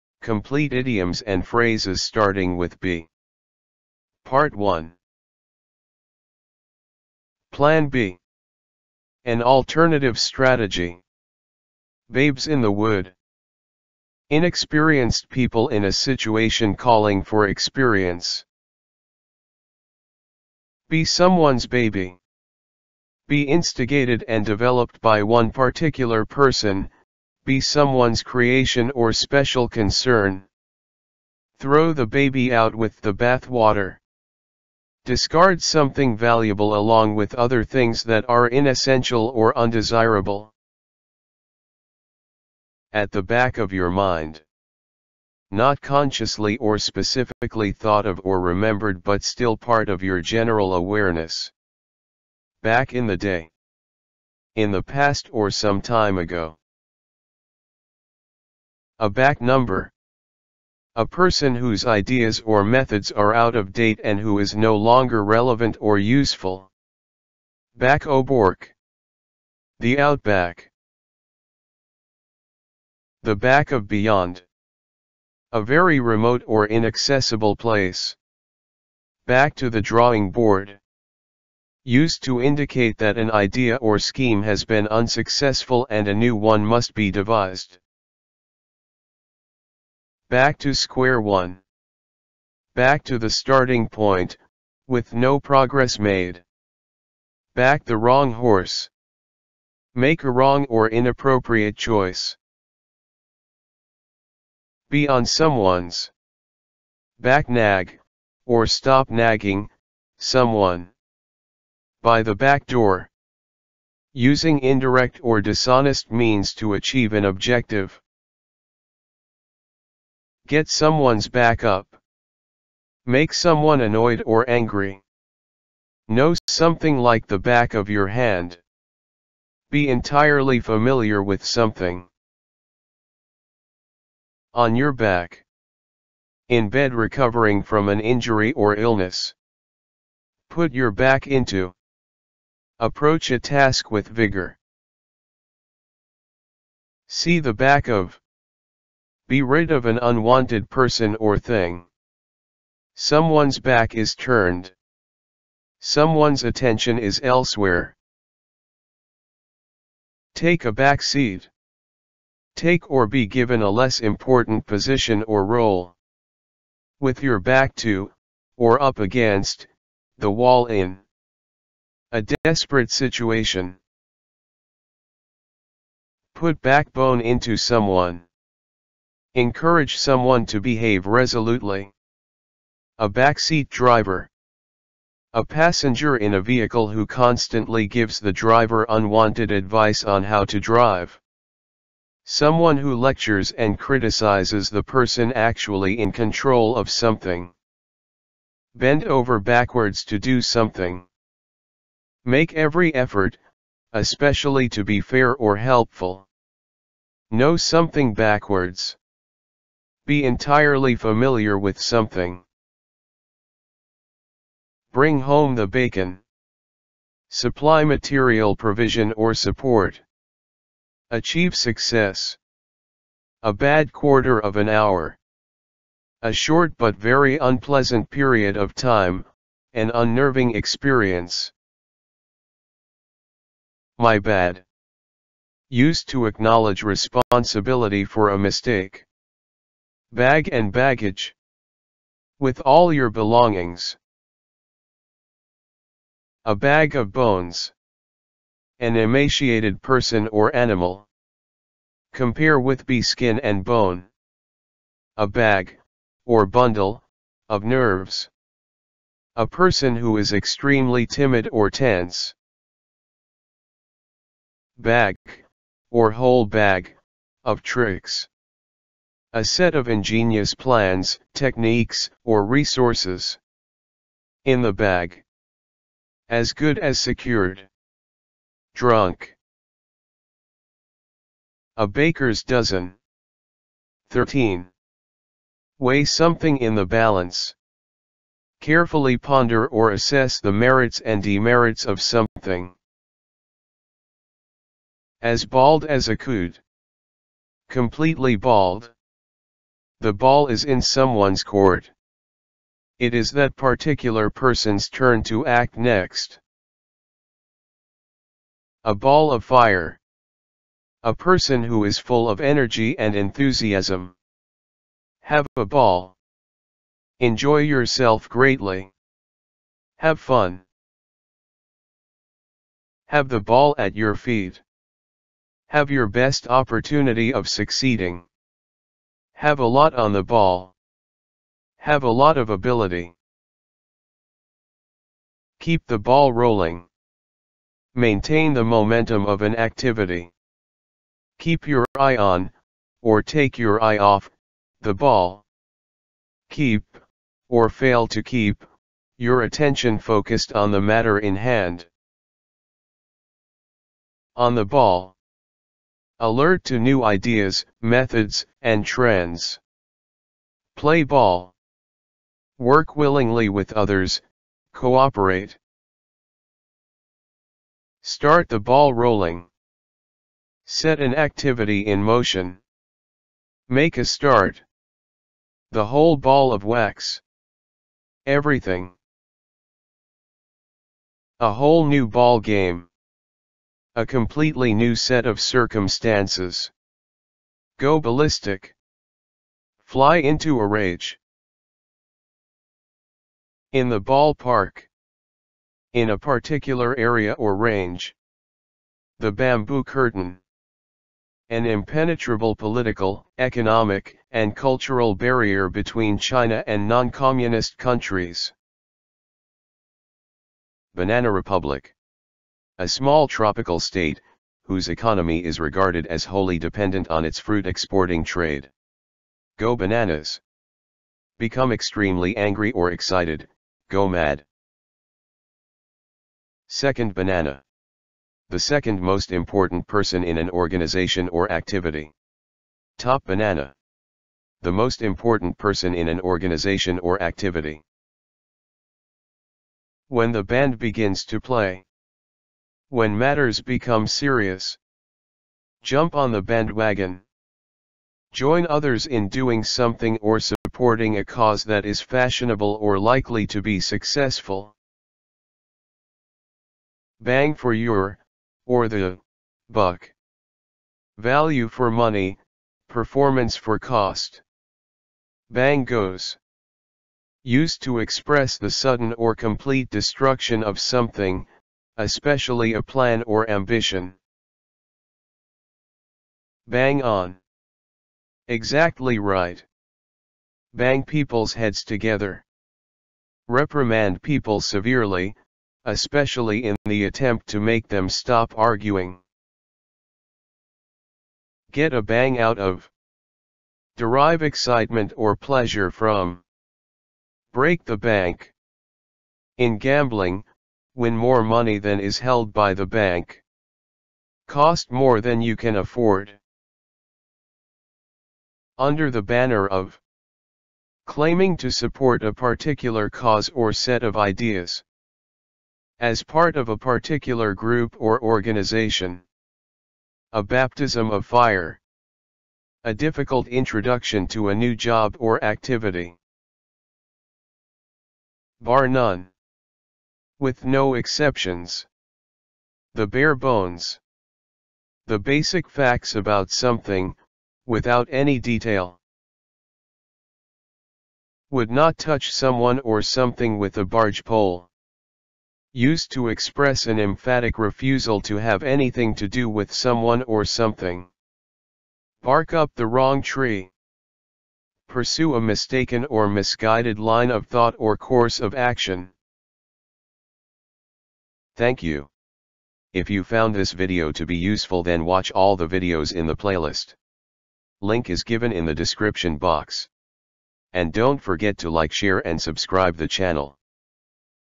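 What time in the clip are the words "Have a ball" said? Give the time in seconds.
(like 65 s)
315 s.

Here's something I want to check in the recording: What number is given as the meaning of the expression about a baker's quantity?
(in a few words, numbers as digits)
13.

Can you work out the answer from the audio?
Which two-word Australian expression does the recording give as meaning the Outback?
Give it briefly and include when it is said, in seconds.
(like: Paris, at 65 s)
Back Bourke, at 67 s.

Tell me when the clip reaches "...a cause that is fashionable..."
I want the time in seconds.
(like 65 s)
451 s.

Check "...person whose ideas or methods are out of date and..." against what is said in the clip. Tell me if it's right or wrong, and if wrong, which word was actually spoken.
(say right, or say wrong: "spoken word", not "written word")
right.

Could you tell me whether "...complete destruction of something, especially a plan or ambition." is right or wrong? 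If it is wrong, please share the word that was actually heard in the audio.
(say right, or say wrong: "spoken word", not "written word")
right.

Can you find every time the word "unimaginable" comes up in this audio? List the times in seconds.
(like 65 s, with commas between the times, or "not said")
not said.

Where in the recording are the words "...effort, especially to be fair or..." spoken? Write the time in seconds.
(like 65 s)
202 s.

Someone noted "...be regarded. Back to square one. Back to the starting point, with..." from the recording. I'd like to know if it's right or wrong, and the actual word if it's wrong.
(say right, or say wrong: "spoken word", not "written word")
wrong: "devised", not "regarded".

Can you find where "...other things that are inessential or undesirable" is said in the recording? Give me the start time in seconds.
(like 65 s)
37 s.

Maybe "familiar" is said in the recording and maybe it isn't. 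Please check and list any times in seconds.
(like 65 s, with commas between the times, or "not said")
130 s, 210 s.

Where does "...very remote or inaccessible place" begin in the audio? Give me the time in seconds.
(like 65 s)
75 s.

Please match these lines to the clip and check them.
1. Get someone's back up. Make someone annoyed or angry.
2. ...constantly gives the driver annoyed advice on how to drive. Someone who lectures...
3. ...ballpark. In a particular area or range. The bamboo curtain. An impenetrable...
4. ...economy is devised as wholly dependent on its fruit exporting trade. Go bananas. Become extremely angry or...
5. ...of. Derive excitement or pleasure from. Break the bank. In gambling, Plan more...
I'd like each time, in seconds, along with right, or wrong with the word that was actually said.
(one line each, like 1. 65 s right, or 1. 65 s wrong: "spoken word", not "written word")
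1. 120 s right
2. 187 s wrong: "unwanted", not "annoyed"
3. 393 s right
4. 414 s wrong: "regarded", not "devised"
5. 492 s wrong: "Win", not "Plan".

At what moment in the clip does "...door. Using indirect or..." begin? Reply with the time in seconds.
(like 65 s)
112 s.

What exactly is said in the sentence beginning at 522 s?
A difficult introduction to a new job or activity.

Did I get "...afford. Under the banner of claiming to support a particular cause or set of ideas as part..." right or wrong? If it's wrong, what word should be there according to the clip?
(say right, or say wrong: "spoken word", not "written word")
right.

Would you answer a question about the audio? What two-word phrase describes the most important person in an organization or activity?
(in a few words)
Top banana.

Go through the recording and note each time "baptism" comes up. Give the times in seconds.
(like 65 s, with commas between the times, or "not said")
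520 s.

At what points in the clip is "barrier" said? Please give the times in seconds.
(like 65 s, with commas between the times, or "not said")
405 s.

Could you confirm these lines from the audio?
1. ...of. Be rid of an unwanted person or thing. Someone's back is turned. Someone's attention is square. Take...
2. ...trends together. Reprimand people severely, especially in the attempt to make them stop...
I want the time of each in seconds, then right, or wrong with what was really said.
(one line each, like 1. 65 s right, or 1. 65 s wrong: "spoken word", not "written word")
1. 147 s wrong: "elsewhere", not "square"
2. 481 s wrong: "heads", not "trends".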